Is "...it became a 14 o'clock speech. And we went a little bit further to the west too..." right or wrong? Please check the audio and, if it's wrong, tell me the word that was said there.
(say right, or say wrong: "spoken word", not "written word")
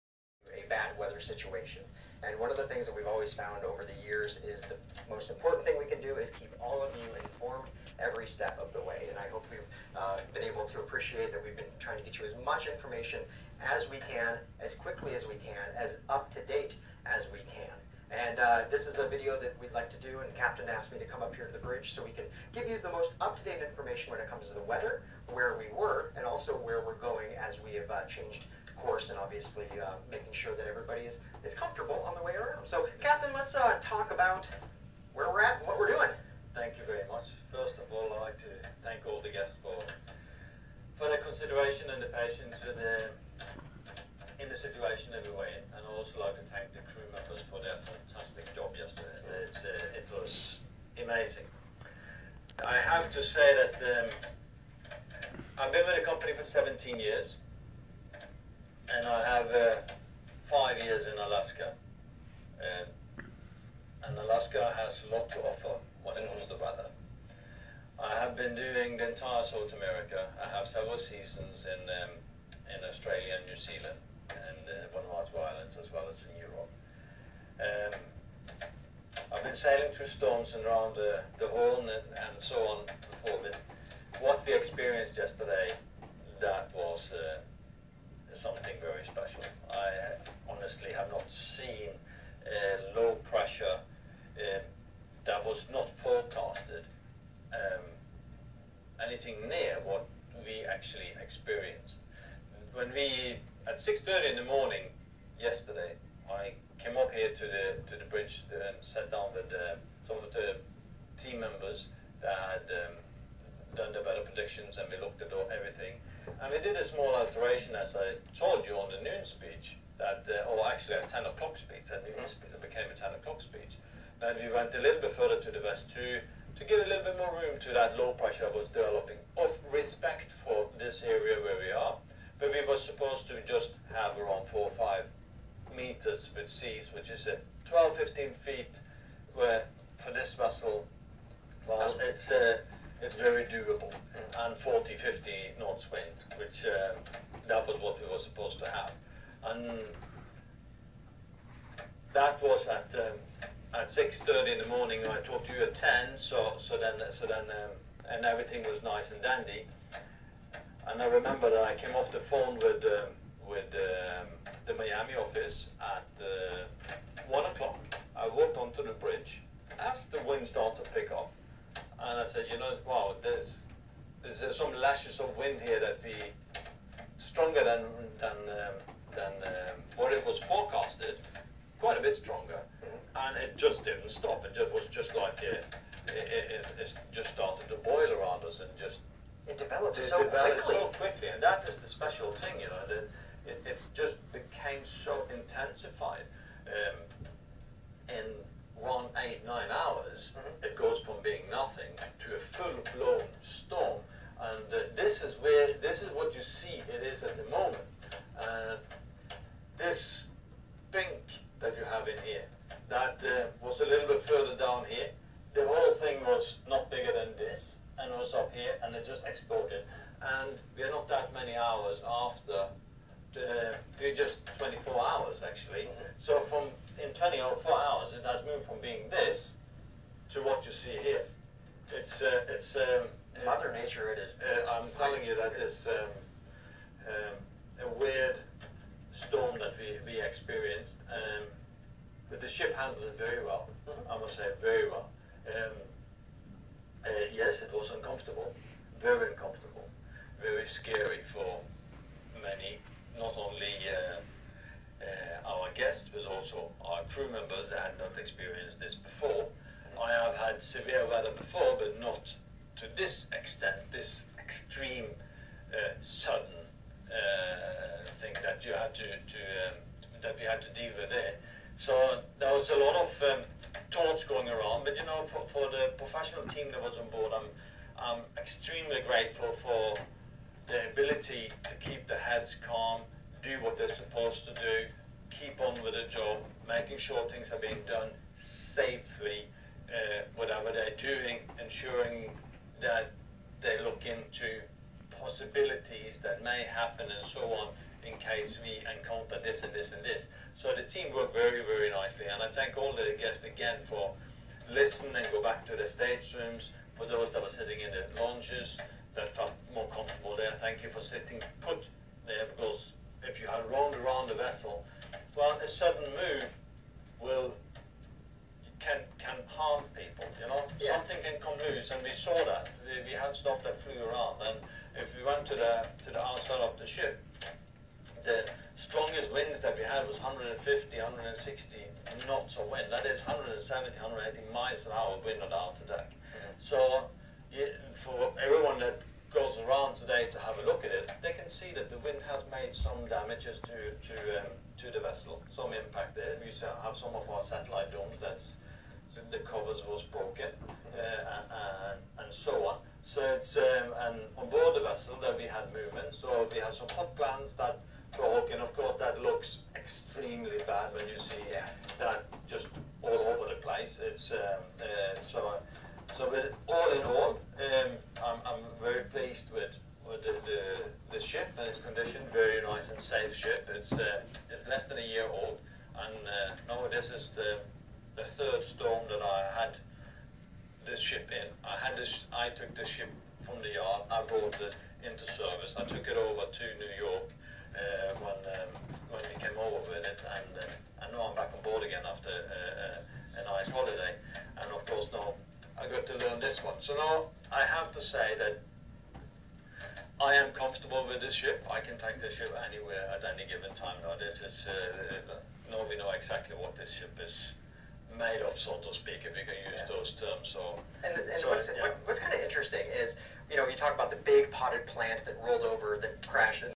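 wrong: "10", not "14".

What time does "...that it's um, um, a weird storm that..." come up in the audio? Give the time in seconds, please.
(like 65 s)
235 s.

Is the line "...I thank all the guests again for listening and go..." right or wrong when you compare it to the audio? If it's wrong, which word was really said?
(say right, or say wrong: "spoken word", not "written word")
right.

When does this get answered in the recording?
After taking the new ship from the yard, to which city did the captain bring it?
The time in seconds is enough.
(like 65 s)
386 s.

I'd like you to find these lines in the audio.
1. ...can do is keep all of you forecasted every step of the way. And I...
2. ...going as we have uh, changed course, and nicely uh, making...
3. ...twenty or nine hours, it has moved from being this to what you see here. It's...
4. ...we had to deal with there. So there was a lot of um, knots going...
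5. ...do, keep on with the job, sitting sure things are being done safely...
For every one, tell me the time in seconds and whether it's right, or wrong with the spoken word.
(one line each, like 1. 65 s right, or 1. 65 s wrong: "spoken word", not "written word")
1. 5 s wrong: "informed", not "forecasted"
2. 26 s wrong: "obviously", not "nicely"
3. 227 s wrong: "four", not "nine"
4. 270 s wrong: "thoughts", not "knots"
5. 284 s wrong: "making", not "sitting".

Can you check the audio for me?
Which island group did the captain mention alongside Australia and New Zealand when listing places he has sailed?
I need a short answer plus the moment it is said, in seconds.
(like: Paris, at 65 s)
Vanuatu Islands, at 74 s.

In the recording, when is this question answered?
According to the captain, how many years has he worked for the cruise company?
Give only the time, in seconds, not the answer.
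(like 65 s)
56 s.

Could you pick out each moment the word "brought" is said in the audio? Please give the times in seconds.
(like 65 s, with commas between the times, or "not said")
384 s.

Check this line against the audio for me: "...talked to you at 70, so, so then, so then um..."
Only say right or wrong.
wrong.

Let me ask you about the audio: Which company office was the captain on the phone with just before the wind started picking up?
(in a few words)
Miami office.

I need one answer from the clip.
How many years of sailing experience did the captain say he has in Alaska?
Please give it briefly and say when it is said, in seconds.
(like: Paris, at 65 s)
5 years, at 60 s.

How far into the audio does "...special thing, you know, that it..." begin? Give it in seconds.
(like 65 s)
191 s.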